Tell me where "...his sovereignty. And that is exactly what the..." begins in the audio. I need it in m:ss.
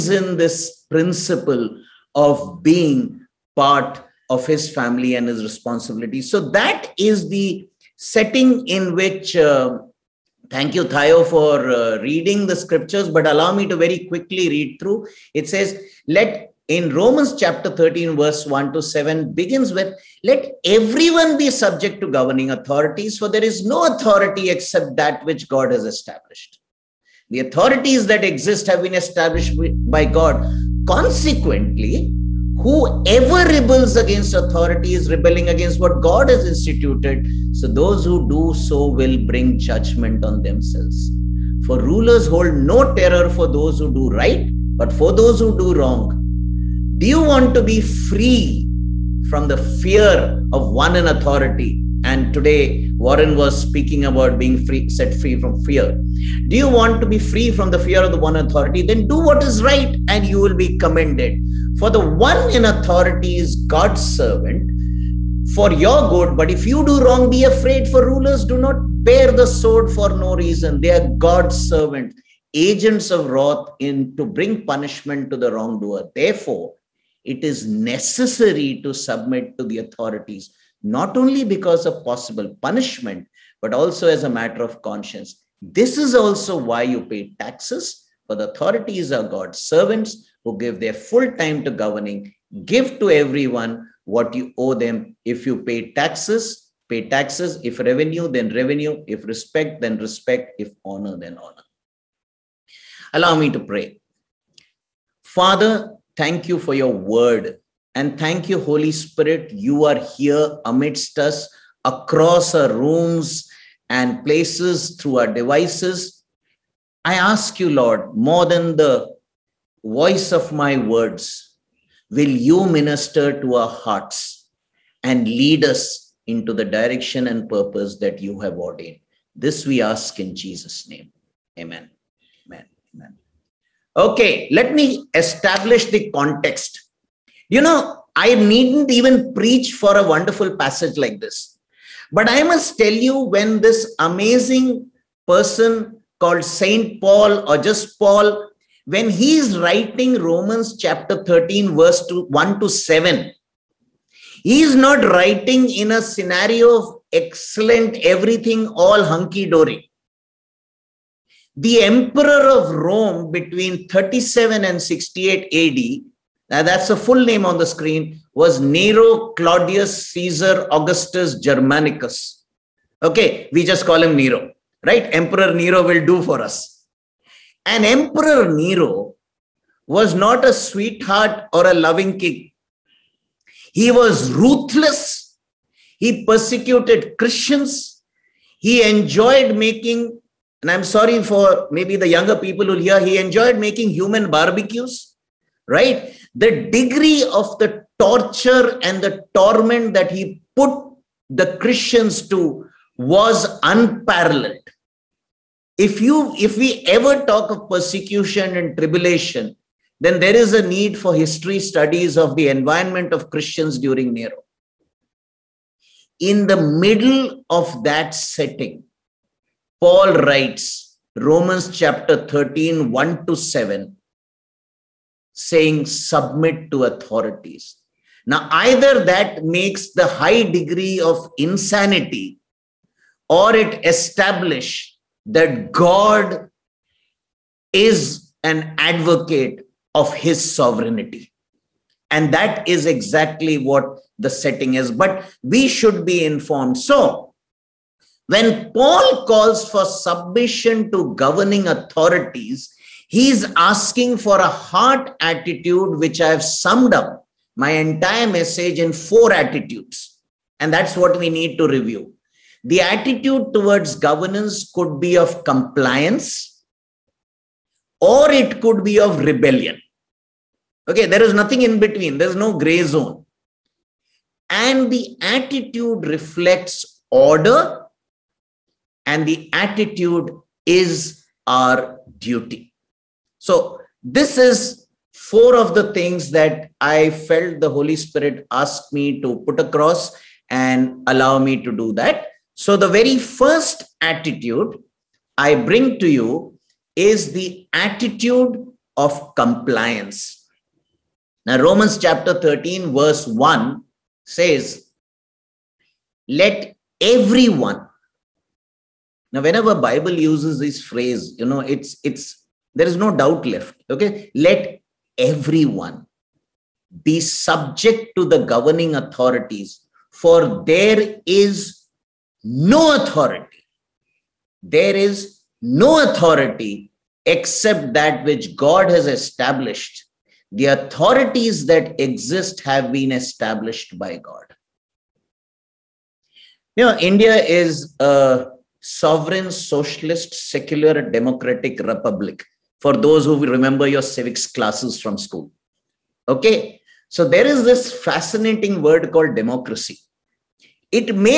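4:00.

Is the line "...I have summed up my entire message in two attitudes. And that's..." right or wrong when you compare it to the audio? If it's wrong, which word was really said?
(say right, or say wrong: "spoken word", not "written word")
wrong: "four", not "two".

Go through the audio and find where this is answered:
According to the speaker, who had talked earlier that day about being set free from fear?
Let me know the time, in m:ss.
0:52.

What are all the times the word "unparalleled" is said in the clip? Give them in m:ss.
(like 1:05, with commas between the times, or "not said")
3:23.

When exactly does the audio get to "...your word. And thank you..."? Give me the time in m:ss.
1:46.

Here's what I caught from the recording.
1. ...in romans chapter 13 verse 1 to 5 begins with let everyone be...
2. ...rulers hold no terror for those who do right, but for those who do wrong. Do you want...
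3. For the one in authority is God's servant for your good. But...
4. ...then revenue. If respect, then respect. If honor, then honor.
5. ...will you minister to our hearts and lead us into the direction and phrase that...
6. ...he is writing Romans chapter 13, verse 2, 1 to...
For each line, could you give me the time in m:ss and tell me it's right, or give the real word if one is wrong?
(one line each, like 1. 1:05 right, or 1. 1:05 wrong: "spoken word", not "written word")
1. 0:16 wrong: "7", not "5"
2. 0:41 right
3. 1:01 right
4. 1:38 right
5. 2:02 wrong: "purpose", not "phrase"
6. 2:29 right.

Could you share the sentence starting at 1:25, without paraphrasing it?
This is also why you pay taxes, for the authorities are God's servants who give their full time to governing.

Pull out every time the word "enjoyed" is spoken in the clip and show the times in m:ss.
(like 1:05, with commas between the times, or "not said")
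3:08, 3:13.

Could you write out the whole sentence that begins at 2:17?
You know, I needn't even preach for a wonderful passage like this.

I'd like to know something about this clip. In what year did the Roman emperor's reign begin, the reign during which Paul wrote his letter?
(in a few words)
37 AD.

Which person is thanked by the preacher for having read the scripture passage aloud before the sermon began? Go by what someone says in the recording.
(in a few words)
Thayo.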